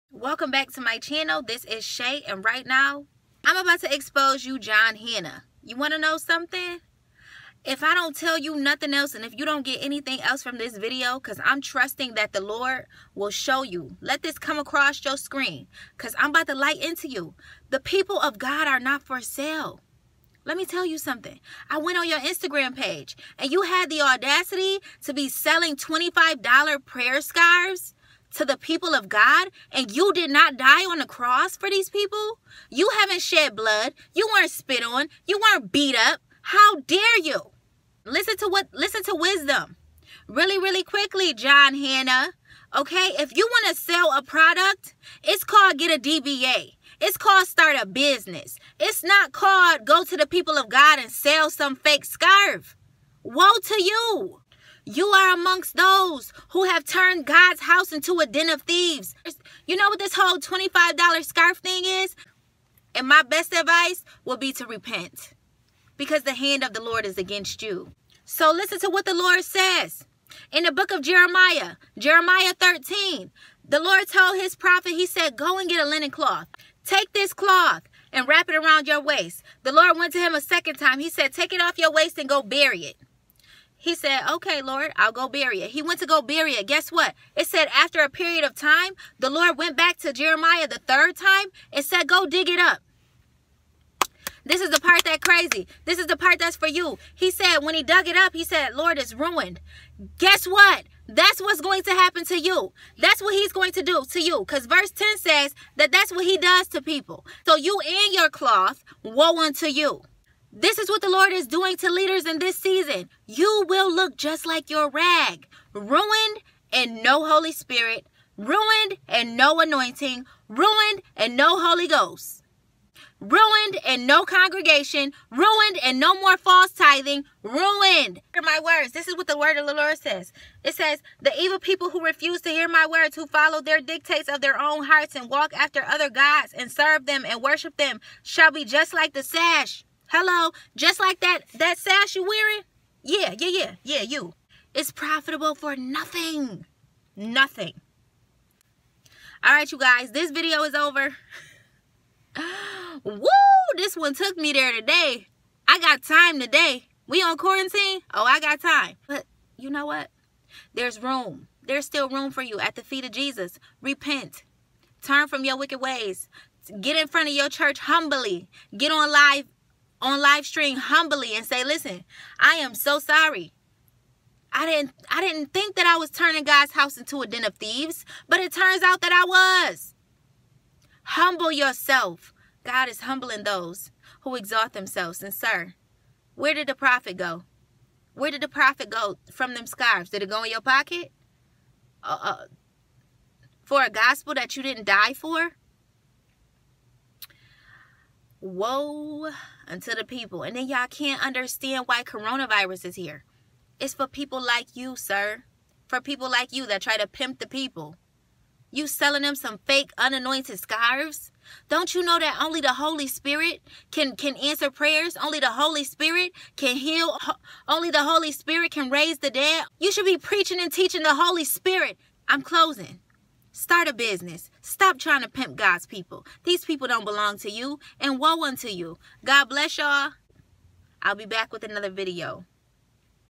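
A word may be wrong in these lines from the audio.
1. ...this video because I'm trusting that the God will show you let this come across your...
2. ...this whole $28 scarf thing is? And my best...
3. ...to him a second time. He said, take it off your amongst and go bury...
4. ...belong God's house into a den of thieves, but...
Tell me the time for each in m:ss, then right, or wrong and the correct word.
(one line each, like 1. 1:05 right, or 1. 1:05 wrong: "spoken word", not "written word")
1. 0:10 wrong: "Lord", not "God"
2. 0:59 wrong: "25", not "28"
3. 1:20 wrong: "waist", not "amongst"
4. 2:56 wrong: "turning", not "belong".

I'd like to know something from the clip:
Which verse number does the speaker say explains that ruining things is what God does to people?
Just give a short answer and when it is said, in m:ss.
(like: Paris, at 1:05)
10, at 1:44.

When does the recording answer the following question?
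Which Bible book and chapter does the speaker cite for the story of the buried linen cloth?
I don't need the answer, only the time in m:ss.
1:11.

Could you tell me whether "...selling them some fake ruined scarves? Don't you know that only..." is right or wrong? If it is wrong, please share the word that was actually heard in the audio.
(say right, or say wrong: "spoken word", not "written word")
wrong: "unanointed", not "ruined".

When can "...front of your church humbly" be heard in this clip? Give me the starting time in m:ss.
2:47.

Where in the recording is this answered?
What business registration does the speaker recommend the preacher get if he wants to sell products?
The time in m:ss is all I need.
0:46.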